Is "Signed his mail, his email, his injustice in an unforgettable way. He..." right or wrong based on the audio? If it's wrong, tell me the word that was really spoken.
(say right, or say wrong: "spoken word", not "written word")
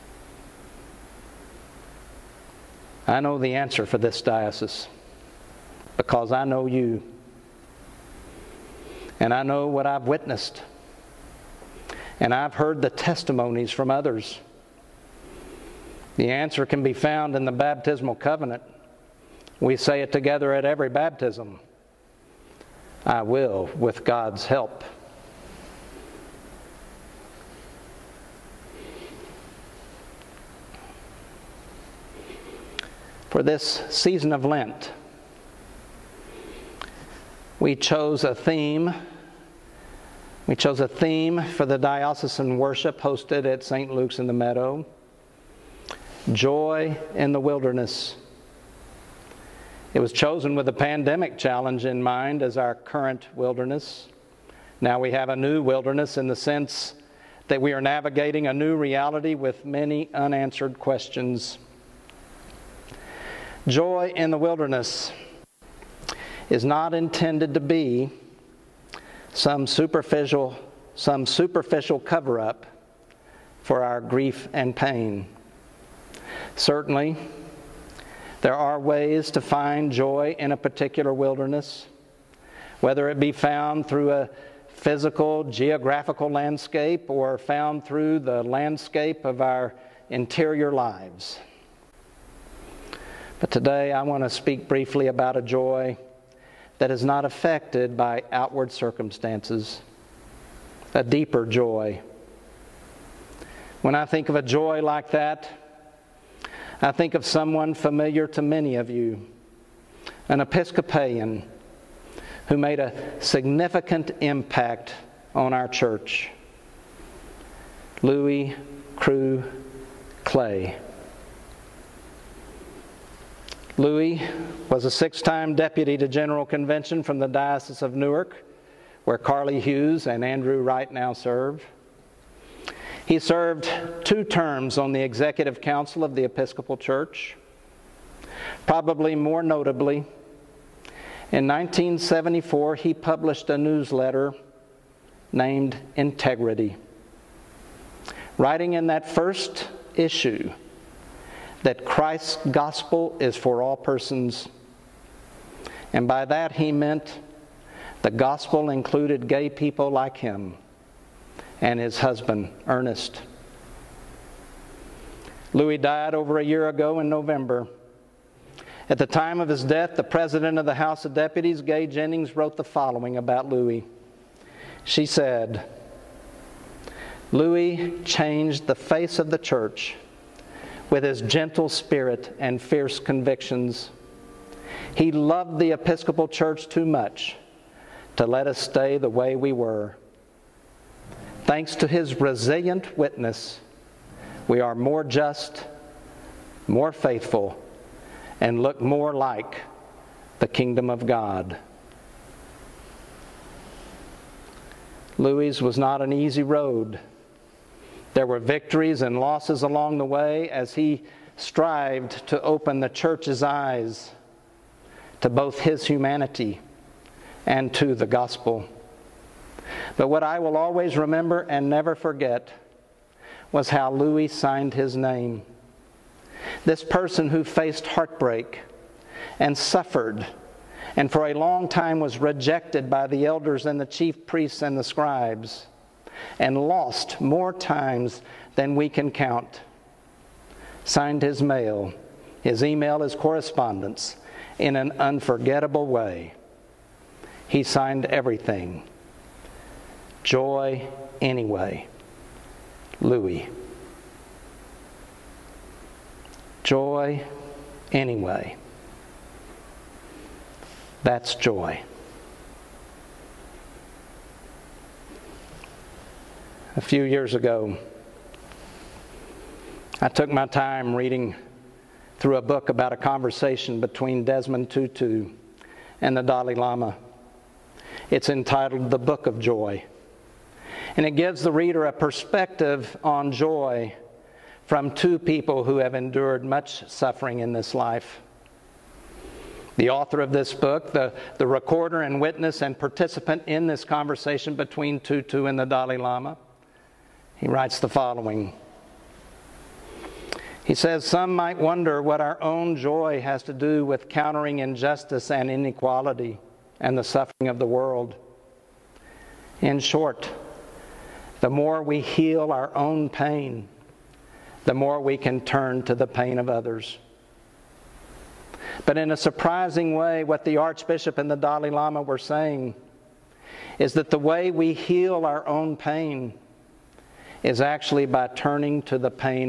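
wrong: "correspondence", not "injustice".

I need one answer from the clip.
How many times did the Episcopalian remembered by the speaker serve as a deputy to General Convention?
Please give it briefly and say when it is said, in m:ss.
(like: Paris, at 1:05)
6, at 2:04.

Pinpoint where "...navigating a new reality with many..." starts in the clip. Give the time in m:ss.
0:57.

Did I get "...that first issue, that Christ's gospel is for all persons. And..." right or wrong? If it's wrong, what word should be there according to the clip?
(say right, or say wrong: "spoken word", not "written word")
right.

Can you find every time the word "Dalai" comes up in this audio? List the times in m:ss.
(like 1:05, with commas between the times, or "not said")
4:36, 4:55, 5:21.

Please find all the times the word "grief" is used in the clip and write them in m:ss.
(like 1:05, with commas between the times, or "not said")
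1:13.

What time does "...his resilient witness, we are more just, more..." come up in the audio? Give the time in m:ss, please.
3:11.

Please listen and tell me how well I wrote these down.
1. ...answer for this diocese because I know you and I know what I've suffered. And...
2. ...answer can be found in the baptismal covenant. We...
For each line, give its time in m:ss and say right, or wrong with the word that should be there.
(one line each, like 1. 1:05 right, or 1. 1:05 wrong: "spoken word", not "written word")
1. 0:03 wrong: "witnessed", not "suffered"
2. 0:16 right.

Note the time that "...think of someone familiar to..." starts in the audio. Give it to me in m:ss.
1:46.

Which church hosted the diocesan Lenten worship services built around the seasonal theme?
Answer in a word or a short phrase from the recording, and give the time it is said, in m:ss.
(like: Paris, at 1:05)
St. 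Luke's in the Meadow, at 0:43.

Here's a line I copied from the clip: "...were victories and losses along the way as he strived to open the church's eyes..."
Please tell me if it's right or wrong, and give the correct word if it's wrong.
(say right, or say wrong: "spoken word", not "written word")
right.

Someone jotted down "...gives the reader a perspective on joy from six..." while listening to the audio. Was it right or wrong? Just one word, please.
wrong.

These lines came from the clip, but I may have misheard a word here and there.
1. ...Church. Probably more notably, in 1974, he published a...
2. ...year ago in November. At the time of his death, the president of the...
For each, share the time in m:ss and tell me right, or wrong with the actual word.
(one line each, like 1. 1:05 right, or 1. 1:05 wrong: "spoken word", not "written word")
1. 2:16 right
2. 2:46 right.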